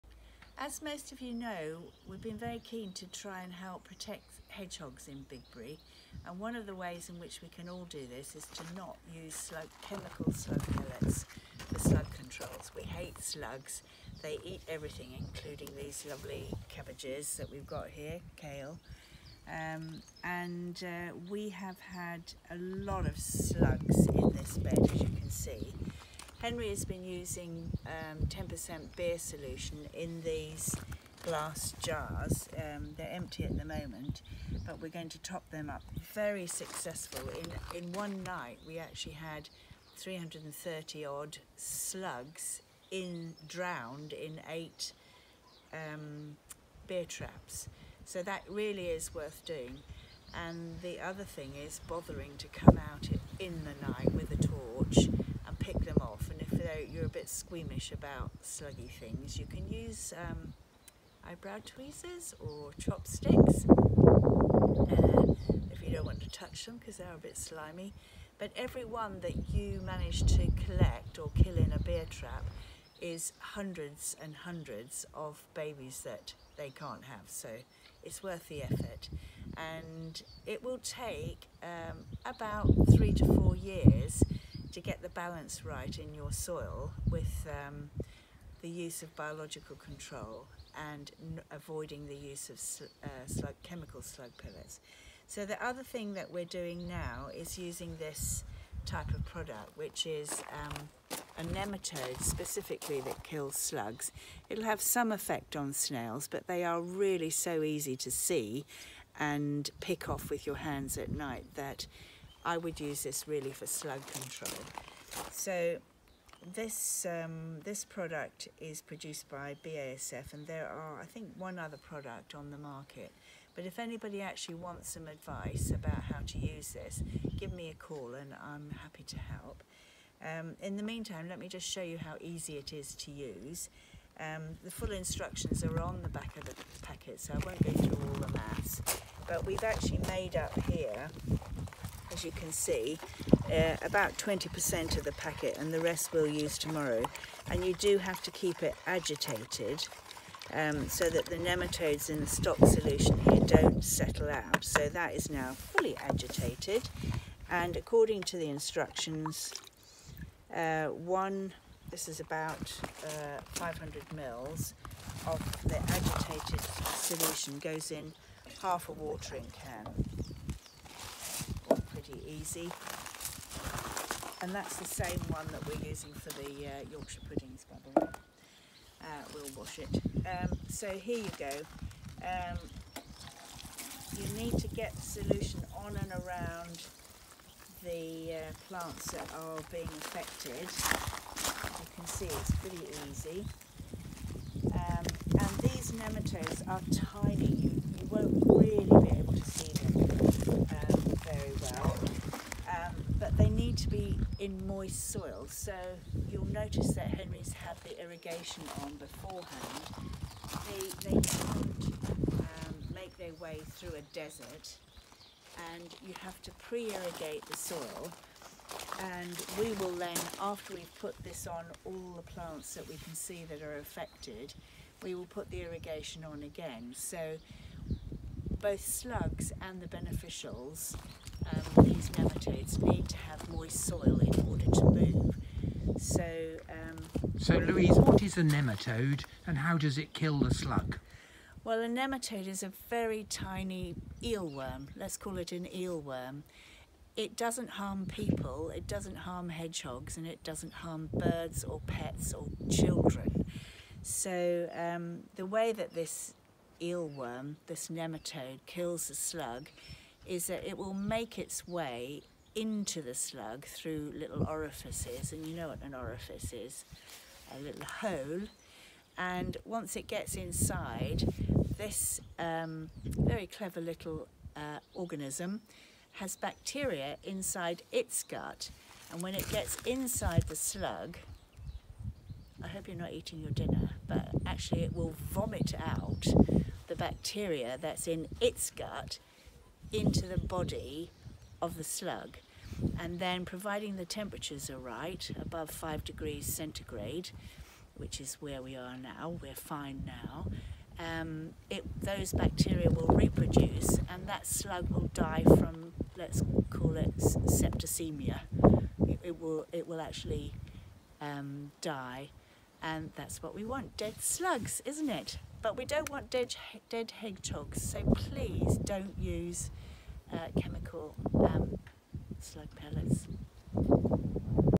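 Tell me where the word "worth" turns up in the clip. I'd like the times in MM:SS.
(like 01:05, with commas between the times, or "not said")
00:49, 01:18.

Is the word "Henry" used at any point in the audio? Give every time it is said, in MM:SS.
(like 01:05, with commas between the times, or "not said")
00:26, 03:27.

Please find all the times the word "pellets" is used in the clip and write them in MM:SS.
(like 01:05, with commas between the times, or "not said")
00:10, 01:34, 05:22.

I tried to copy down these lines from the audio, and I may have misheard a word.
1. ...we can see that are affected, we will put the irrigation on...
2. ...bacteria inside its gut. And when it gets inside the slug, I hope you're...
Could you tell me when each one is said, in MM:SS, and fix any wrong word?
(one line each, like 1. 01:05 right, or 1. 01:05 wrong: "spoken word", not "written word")
1. 03:42 right
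2. 04:36 right.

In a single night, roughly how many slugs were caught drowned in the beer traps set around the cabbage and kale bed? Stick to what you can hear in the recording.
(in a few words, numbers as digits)
330.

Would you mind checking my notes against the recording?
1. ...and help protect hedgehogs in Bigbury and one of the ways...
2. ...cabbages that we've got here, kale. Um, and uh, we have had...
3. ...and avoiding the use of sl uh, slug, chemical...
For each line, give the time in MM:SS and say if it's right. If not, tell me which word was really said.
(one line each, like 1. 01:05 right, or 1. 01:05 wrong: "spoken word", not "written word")
1. 00:03 right
2. 00:16 right
3. 01:30 right.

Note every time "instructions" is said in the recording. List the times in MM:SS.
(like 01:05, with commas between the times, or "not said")
02:14, 02:38.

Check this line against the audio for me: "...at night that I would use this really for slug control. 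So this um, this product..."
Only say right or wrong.
right.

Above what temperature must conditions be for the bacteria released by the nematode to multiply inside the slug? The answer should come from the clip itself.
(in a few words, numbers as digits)
5 degrees centigrade.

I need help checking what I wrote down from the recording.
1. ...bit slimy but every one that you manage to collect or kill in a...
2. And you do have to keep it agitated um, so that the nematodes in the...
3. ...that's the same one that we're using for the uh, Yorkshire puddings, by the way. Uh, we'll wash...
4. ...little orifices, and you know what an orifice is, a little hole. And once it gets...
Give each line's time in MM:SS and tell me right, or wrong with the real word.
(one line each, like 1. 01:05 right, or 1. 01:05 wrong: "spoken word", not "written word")
1. 01:07 right
2. 02:27 right
3. 02:54 right
4. 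04:24 right.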